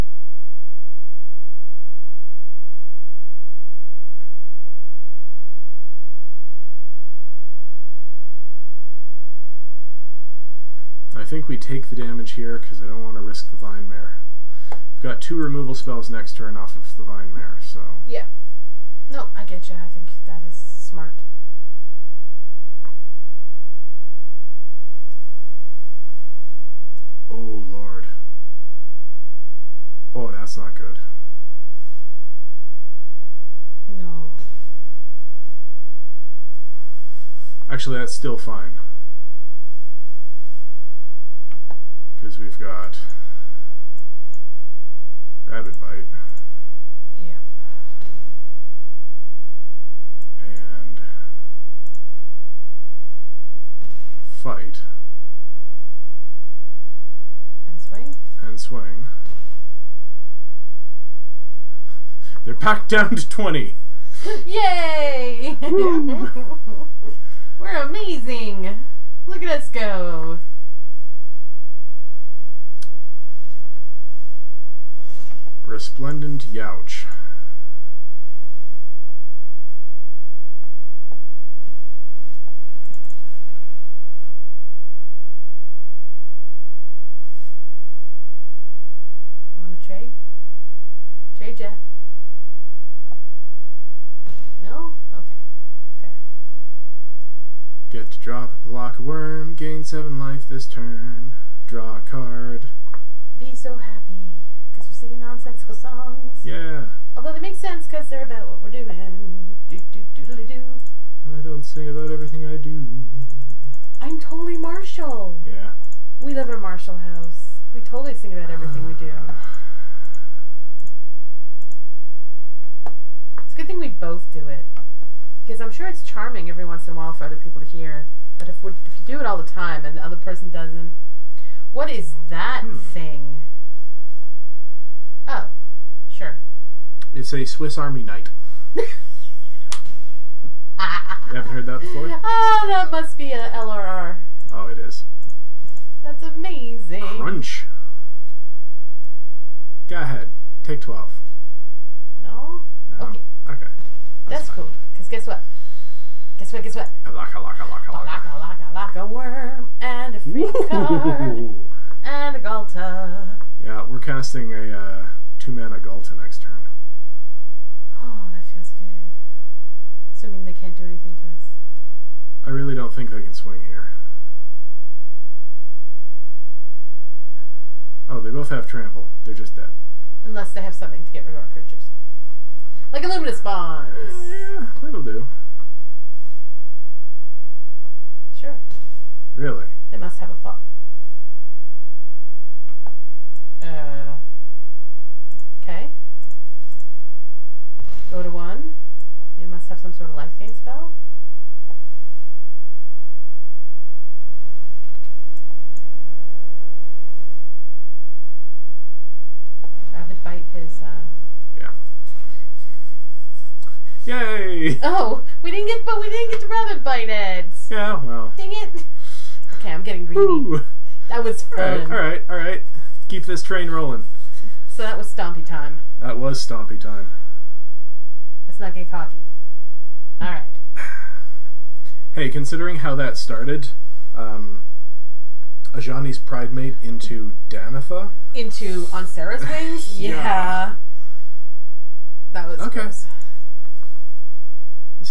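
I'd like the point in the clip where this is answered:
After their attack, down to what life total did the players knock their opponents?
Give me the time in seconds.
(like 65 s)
63 s.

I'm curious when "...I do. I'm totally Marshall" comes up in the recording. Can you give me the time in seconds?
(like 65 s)
112 s.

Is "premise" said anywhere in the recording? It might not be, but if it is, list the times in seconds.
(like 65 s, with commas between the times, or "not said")
not said.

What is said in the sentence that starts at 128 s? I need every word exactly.
But if, if you do it all the time and the other person doesn't, what is that hmm.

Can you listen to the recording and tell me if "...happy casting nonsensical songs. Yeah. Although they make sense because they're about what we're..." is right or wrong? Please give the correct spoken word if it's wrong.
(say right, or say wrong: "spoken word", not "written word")
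wrong: "singing", not "casting".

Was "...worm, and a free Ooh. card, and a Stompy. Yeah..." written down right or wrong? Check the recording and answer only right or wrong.
wrong.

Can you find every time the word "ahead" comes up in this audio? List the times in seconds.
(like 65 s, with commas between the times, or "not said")
150 s.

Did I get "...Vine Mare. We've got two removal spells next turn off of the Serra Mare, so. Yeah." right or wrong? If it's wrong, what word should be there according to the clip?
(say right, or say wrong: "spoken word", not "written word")
wrong: "Vine", not "Serra".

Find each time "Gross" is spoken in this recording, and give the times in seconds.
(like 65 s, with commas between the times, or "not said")
242 s.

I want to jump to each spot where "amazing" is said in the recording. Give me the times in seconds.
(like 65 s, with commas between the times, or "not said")
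67 s, 146 s.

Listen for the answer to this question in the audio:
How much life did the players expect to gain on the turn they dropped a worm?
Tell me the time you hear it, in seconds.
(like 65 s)
99 s.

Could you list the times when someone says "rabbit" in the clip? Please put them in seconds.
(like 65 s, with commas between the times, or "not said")
45 s, 209 s, 216 s.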